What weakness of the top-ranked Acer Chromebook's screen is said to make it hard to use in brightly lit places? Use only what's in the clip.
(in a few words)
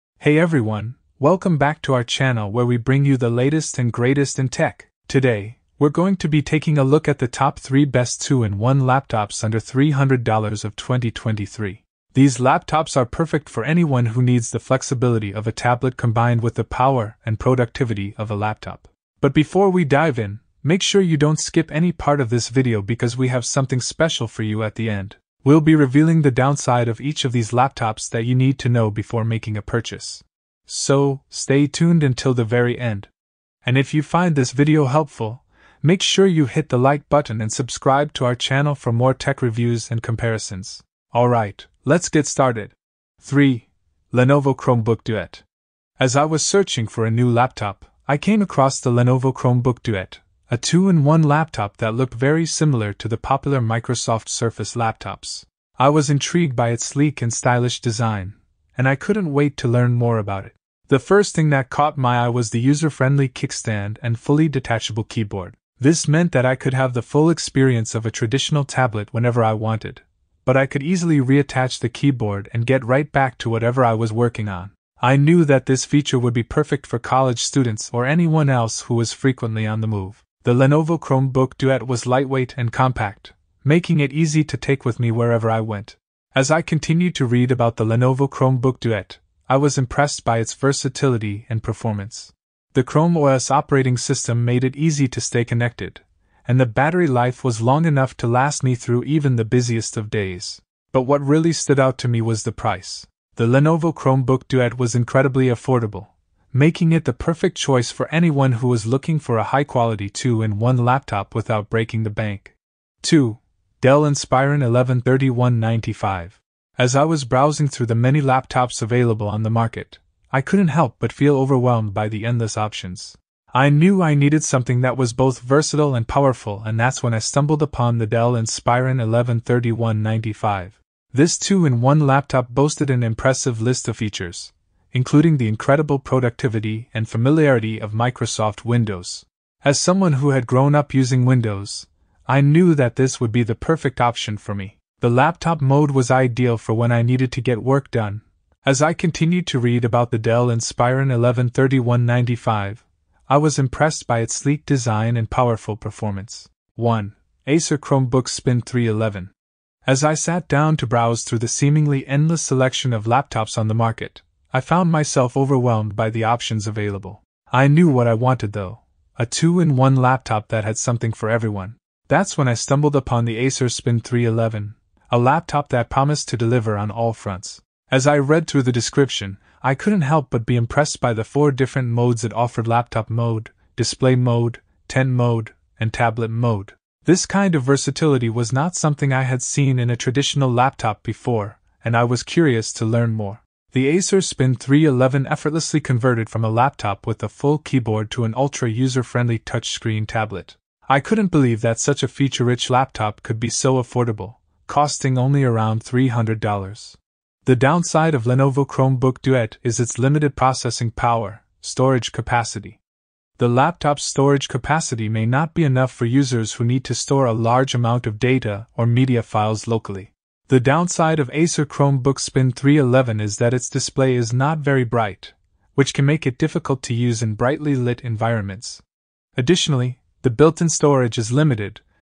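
not very bright.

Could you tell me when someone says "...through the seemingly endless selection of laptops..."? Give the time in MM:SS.
02:41.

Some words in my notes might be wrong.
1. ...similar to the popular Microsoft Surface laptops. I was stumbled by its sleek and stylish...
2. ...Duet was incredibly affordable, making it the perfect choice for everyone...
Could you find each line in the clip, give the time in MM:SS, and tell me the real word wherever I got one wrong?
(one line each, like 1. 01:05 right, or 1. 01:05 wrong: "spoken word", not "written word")
1. 00:52 wrong: "intrigued", not "stumbled"
2. 01:44 wrong: "anyone", not "everyone".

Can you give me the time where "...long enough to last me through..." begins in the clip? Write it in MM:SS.
01:37.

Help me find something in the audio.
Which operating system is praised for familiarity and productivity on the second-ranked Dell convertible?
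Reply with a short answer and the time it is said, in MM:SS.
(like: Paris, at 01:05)
Microsoft Windows, at 02:17.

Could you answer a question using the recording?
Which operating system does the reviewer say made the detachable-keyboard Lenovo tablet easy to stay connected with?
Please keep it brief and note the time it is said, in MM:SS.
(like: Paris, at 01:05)
Chrome OS, at 01:32.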